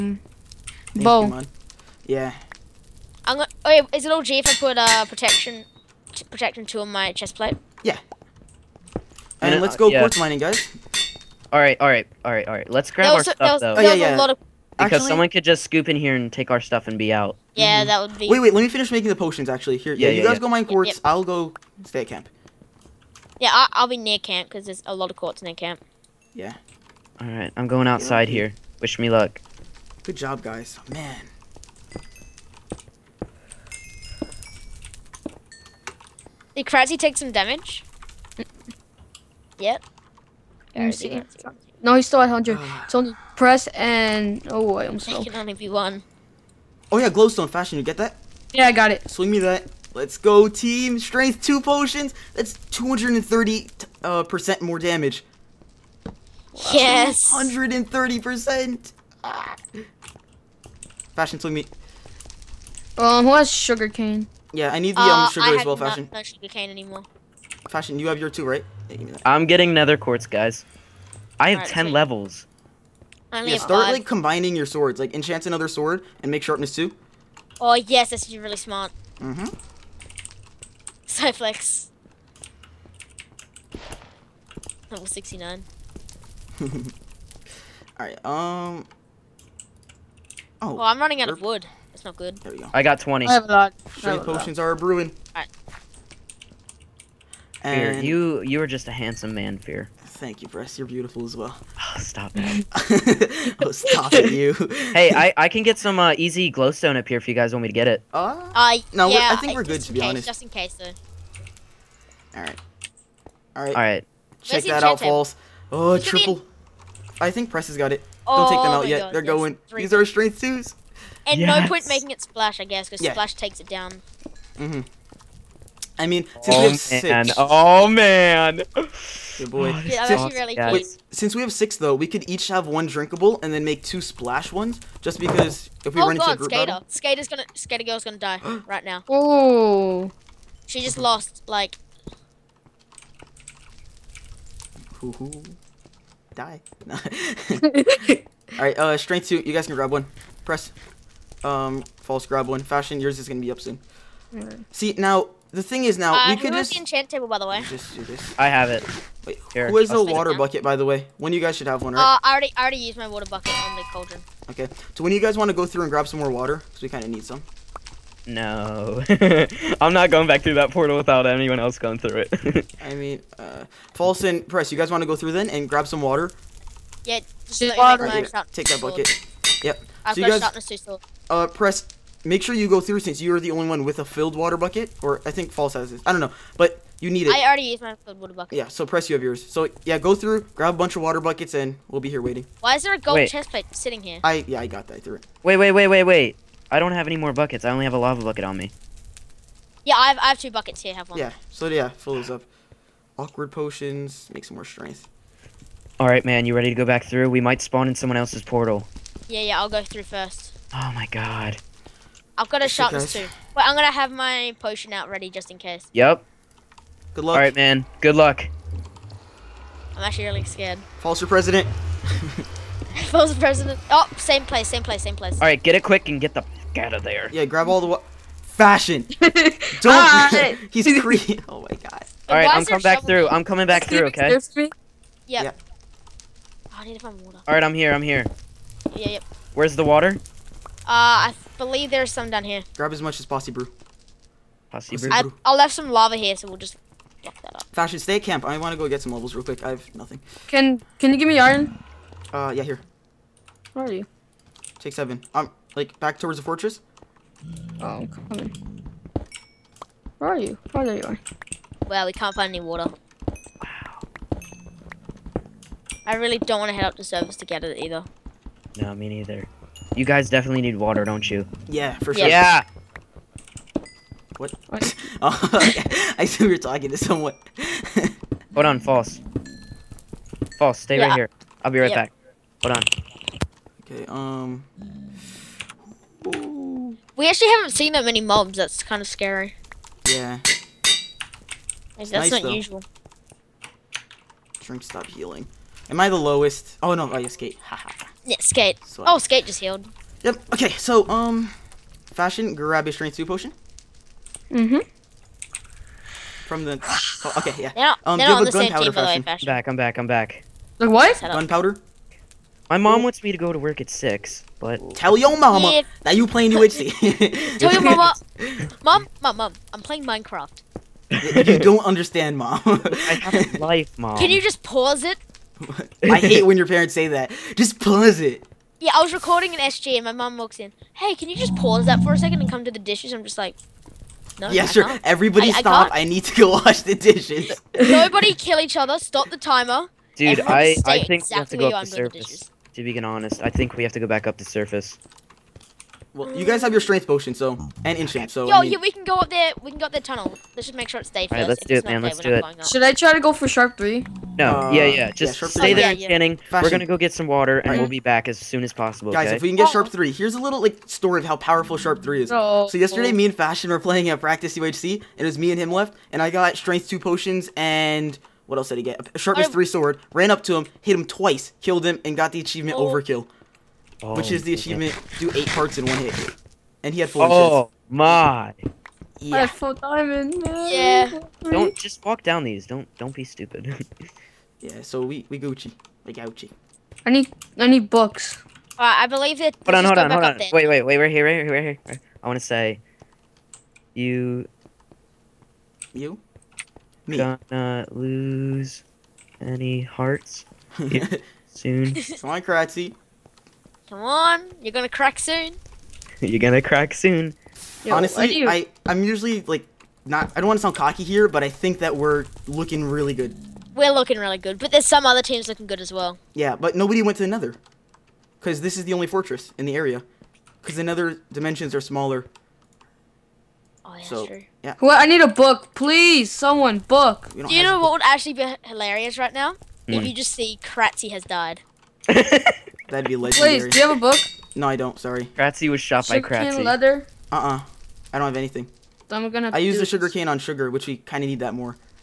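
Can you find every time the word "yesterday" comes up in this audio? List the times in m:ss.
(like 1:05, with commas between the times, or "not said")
6:02.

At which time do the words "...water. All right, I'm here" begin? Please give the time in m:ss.
3:57.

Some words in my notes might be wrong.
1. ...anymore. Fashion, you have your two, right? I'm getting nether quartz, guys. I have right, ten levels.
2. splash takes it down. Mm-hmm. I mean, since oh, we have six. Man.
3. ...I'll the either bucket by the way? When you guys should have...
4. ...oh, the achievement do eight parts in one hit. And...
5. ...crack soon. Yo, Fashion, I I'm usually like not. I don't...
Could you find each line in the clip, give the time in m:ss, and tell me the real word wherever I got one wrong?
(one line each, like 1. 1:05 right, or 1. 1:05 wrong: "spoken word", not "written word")
1. 1:06 right
2. 2:03 right
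3. 2:39 wrong: "water", not "either"
4. 6:14 right
5. 6:46 wrong: "Honestly", not "Fashion".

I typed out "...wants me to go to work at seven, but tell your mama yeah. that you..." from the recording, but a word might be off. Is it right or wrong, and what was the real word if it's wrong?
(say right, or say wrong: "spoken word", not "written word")
wrong: "six", not "seven".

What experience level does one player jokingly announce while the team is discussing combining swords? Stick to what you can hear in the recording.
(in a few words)
69.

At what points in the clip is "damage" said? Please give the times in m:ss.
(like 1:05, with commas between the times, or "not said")
0:37, 0:54.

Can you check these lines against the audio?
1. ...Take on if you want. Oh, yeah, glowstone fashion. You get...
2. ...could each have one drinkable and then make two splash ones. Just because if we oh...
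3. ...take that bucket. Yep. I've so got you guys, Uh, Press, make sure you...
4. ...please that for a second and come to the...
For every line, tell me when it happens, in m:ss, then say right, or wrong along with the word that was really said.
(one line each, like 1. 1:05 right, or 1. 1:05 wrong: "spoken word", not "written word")
1. 0:44 right
2. 2:12 right
3. 2:58 right
4. 5:31 wrong: "pause", not "please".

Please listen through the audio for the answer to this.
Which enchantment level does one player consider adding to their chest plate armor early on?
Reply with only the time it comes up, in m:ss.
0:05.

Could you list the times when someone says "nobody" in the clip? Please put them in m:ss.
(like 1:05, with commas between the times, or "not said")
5:37, 6:56.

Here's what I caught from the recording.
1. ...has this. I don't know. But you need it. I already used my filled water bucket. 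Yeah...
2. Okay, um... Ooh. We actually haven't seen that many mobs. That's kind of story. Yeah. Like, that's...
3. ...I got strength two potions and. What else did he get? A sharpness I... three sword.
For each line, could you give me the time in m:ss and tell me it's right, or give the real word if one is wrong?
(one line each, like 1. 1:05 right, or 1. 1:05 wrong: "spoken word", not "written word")
1. 3:05 right
2. 4:43 wrong: "scary", not "story"
3. 6:06 right.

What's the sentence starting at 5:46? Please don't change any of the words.
Well, you guys have your strength potion, so and enchant.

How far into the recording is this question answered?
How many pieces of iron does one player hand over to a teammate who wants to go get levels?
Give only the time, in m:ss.
4:14.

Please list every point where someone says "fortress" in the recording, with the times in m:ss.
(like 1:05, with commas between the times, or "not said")
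4:16, 6:59.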